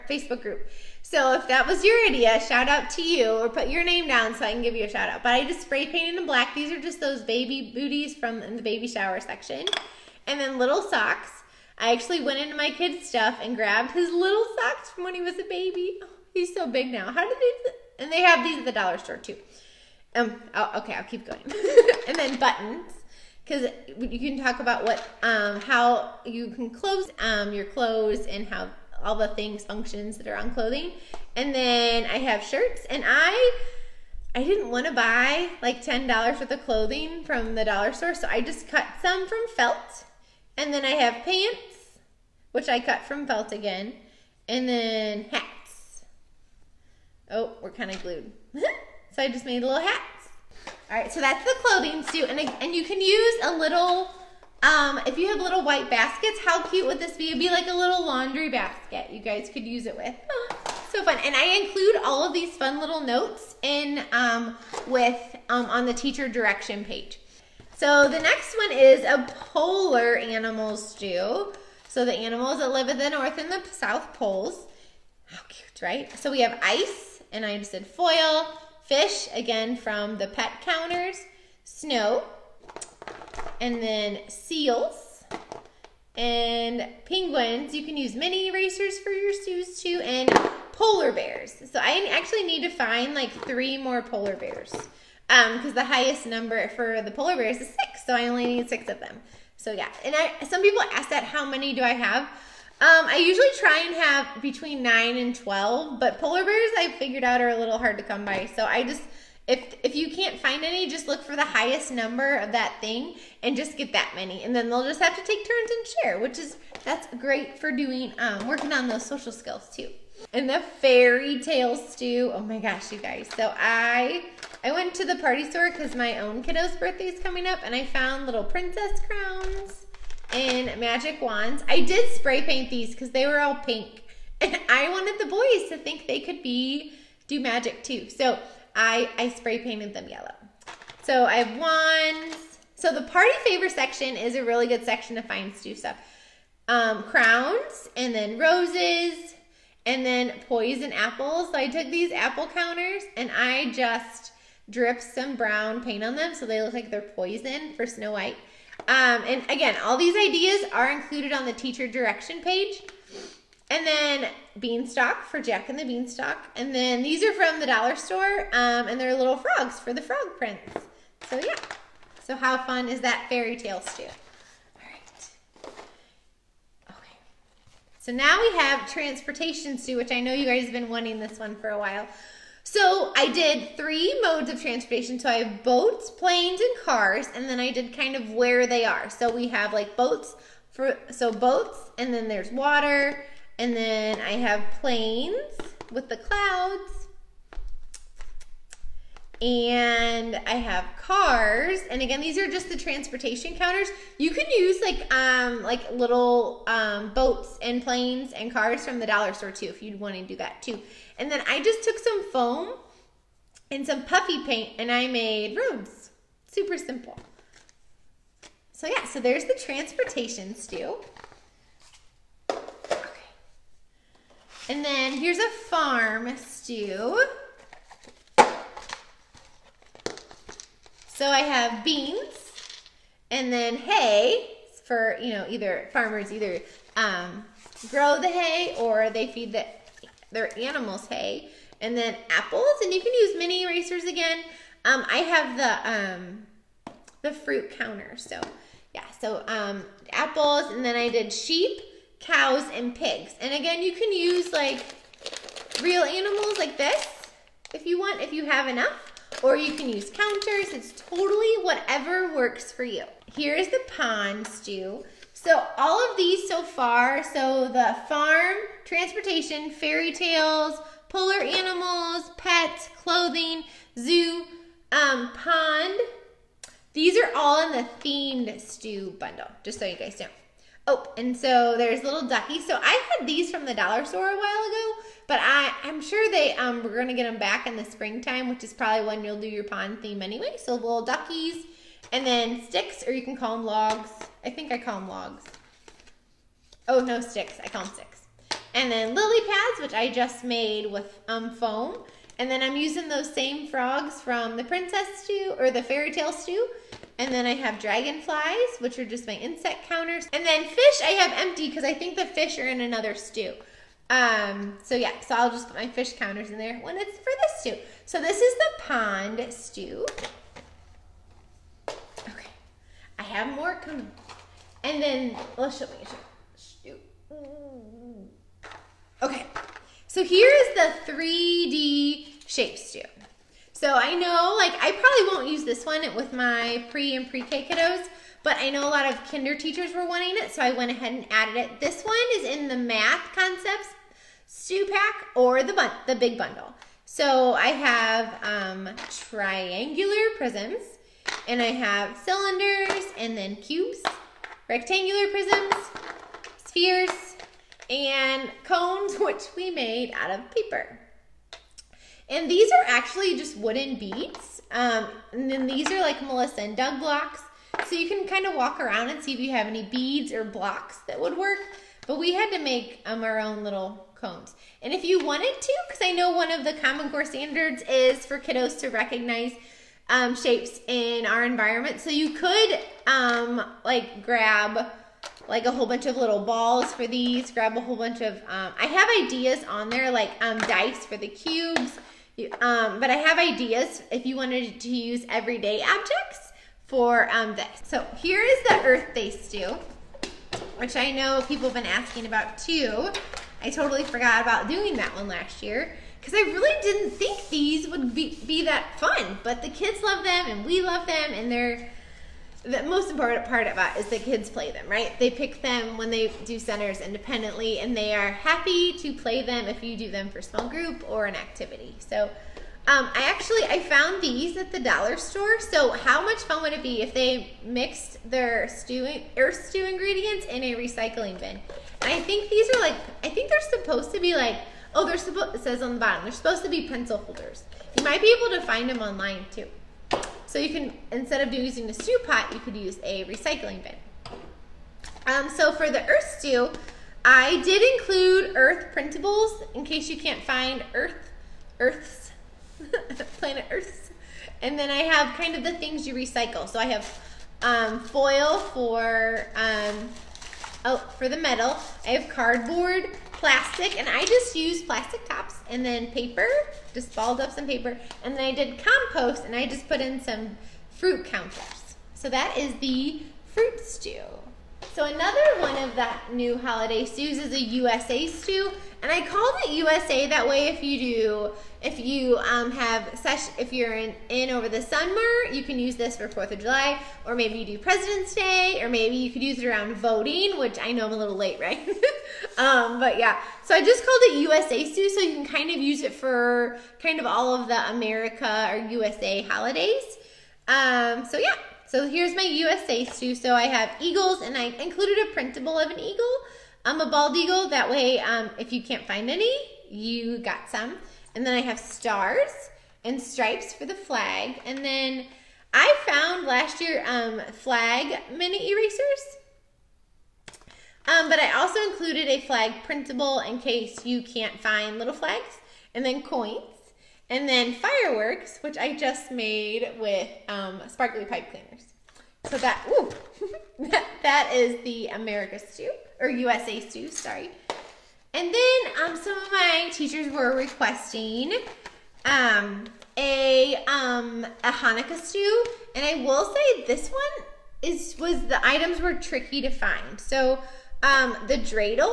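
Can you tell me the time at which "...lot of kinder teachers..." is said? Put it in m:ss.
5:38.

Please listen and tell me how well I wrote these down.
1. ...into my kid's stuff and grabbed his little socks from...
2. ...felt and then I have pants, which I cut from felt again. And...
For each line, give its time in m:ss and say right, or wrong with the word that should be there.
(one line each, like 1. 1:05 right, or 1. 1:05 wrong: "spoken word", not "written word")
1. 0:12 right
2. 0:39 right.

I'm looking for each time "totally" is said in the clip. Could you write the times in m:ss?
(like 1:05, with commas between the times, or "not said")
4:20, 6:43.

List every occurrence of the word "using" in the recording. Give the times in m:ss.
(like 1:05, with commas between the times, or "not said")
5:02, 7:21.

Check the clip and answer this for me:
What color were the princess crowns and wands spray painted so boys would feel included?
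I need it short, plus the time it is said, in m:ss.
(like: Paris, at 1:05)
yellow, at 2:20.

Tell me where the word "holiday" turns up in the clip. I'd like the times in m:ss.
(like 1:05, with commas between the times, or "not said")
7:56, 8:19.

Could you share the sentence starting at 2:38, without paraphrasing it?
Um, and again, all these ideas are included on the teacher direction page.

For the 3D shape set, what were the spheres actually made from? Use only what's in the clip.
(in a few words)
wooden beads.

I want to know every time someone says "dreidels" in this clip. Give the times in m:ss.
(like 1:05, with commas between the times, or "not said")
9:11.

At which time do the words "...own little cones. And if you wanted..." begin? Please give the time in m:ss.
6:13.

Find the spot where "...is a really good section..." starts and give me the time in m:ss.
2:24.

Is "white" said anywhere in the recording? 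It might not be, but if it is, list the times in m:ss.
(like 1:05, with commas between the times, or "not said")
0:55, 2:38.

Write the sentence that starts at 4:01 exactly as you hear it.
And then apples, and you can use mini erasers again.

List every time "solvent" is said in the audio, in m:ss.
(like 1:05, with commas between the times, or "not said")
not said.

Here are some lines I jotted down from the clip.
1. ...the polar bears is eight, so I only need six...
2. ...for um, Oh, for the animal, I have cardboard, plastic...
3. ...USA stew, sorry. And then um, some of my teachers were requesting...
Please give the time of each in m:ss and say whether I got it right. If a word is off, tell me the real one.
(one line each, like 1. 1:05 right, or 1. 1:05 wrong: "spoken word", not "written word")
1. 1:37 wrong: "six", not "eight"
2. 7:38 wrong: "metal", not "animal"
3. 8:56 right.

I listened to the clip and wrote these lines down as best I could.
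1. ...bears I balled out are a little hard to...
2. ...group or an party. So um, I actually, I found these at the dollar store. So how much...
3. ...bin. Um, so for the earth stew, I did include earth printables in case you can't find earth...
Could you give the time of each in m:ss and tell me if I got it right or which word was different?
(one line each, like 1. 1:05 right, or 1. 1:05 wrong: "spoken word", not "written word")
1. 1:46 wrong: "figured", not "balled"
2. 7:00 wrong: "activity", not "party"
3. 7:23 right.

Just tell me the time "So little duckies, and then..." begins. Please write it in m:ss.
4:50.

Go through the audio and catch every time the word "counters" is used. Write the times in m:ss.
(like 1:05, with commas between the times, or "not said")
1:20, 2:32, 3:23, 4:07, 4:20, 5:09, 5:16, 7:51.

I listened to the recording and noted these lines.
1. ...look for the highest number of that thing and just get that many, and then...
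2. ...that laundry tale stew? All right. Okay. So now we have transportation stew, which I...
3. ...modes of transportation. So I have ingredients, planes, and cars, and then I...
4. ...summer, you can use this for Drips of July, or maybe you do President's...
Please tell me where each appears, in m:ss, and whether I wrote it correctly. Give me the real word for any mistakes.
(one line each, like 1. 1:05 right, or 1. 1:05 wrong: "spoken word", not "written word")
1. 1:51 right
2. 2:53 wrong: "fairy", not "laundry"
3. 3:04 wrong: "boats", not "ingredients"
4. 8:04 wrong: "Fourth", not "Drips".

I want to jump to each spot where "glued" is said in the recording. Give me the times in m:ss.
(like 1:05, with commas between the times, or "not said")
0:48.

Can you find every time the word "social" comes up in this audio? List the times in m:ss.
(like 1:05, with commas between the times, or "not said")
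1:59.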